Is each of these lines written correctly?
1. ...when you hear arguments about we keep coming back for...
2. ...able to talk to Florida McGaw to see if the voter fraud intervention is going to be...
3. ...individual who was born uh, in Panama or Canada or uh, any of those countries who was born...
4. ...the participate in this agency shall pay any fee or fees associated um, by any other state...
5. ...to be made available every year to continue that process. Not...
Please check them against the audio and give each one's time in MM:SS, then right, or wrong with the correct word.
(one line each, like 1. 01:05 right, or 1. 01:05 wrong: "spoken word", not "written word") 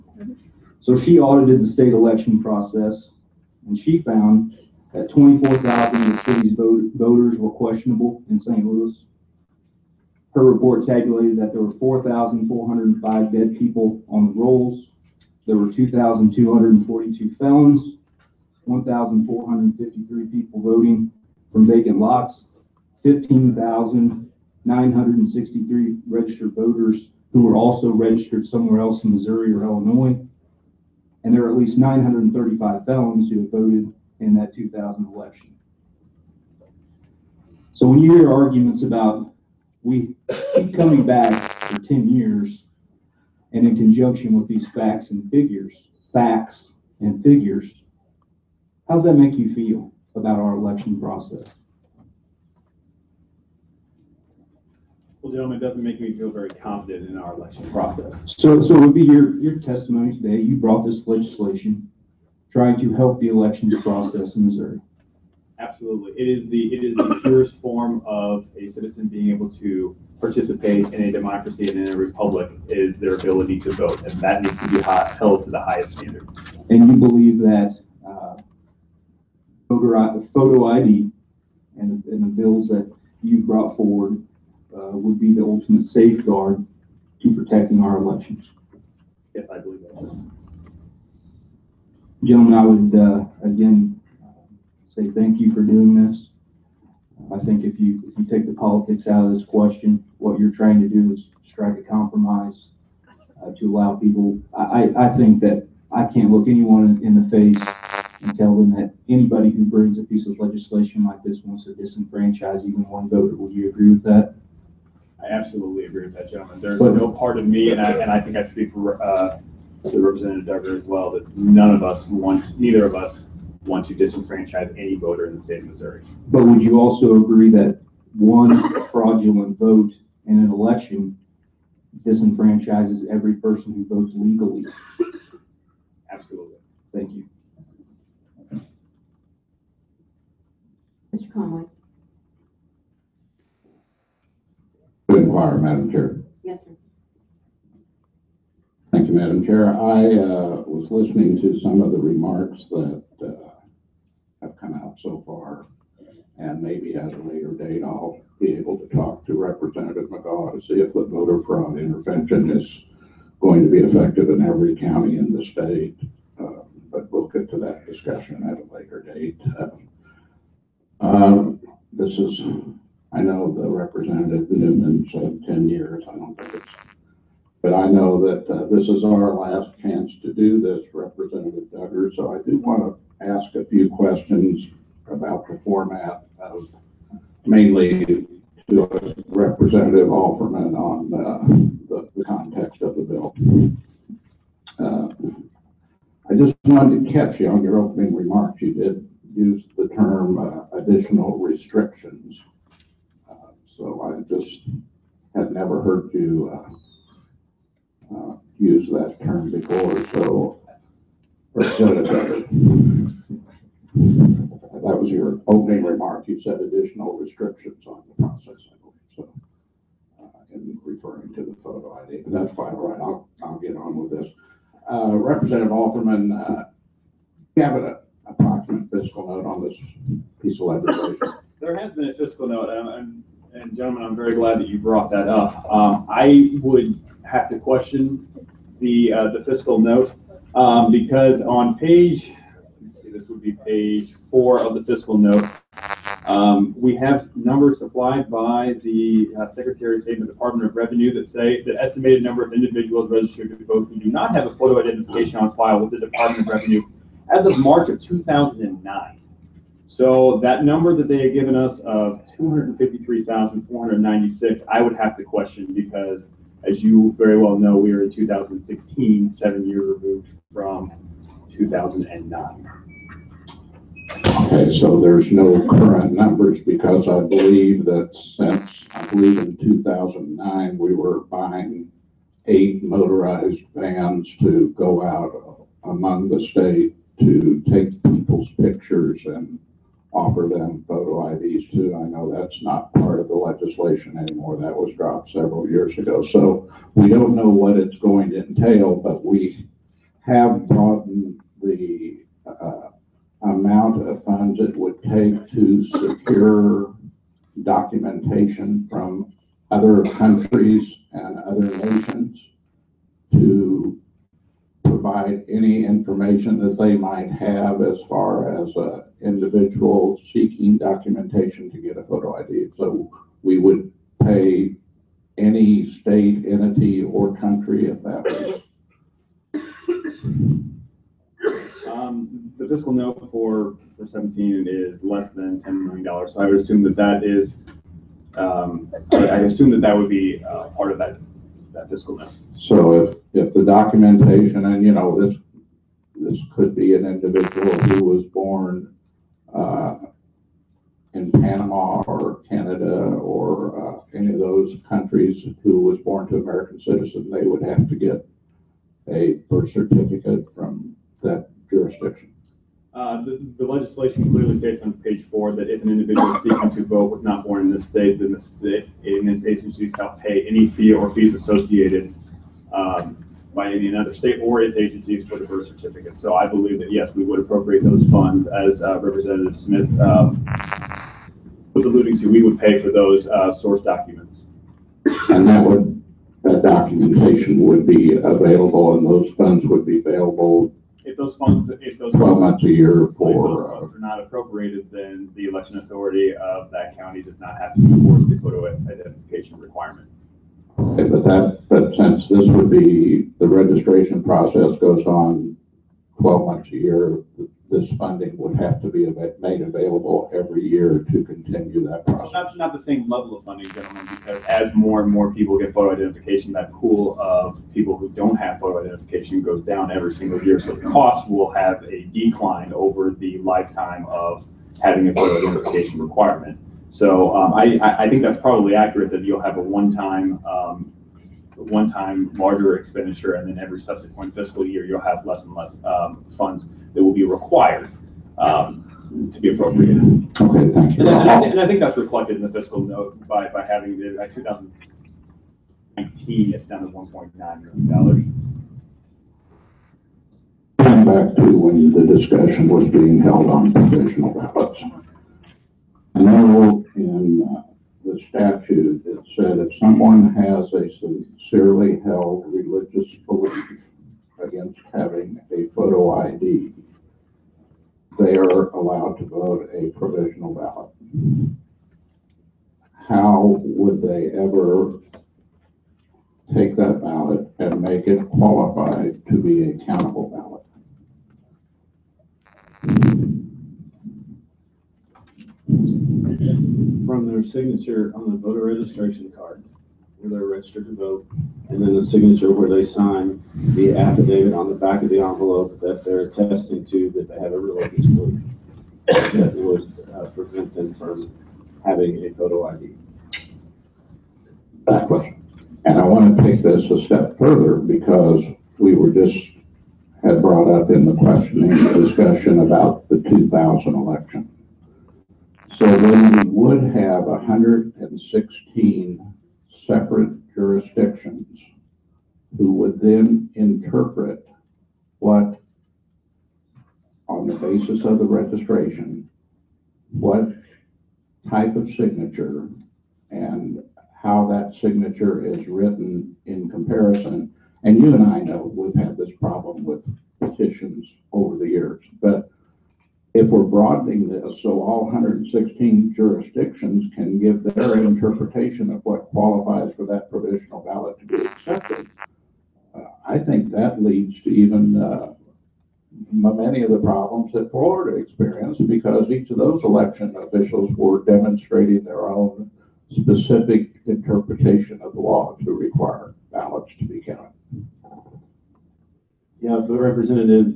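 1. 00:37 right
2. 02:38 wrong: "Representative", not "Florida"
3. 05:47 right
4. 06:08 wrong: "state", not "participate"
5. 06:48 right.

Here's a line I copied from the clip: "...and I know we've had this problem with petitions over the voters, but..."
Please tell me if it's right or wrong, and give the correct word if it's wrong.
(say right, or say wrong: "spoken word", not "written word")
wrong: "years", not "voters".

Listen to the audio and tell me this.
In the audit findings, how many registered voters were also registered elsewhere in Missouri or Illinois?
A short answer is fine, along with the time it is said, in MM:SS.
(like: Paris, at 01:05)
15,963, at 00:23.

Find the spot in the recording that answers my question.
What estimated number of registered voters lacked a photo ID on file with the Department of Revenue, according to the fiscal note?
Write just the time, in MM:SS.
04:22.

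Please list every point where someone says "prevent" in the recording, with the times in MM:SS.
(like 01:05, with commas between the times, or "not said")
08:20.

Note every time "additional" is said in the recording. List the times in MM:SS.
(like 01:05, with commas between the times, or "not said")
03:20, 03:36.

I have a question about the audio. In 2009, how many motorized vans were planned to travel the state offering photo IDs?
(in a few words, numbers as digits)
8.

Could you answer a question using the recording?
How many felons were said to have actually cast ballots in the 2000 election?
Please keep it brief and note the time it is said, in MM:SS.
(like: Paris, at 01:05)
935, at 00:31.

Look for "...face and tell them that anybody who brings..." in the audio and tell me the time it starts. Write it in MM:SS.
01:47.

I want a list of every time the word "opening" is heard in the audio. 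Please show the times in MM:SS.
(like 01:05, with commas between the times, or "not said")
03:17, 03:35.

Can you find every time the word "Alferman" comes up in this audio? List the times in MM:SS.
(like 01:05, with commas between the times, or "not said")
03:10, 03:45.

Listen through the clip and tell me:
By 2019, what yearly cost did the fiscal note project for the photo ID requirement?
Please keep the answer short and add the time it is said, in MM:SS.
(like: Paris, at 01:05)
1.9 million dollars, at 07:26.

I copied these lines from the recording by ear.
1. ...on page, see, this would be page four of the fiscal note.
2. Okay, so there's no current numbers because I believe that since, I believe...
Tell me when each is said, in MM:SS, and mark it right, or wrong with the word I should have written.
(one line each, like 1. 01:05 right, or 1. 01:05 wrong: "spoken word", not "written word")
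1. 04:01 right
2. 04:34 right.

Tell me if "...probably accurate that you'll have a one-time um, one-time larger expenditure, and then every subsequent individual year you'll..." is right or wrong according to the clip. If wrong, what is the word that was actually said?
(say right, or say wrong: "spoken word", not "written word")
wrong: "fiscal", not "individual".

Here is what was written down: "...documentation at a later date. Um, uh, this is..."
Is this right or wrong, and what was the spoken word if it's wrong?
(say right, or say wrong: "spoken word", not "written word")
wrong: "discussion", not "documentation".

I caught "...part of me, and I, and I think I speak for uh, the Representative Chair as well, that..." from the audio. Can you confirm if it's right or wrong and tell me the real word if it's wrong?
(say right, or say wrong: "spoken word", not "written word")
wrong: "Dugger", not "Chair".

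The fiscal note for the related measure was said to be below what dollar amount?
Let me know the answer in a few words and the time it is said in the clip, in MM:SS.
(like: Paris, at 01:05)
$10 million, at 05:35.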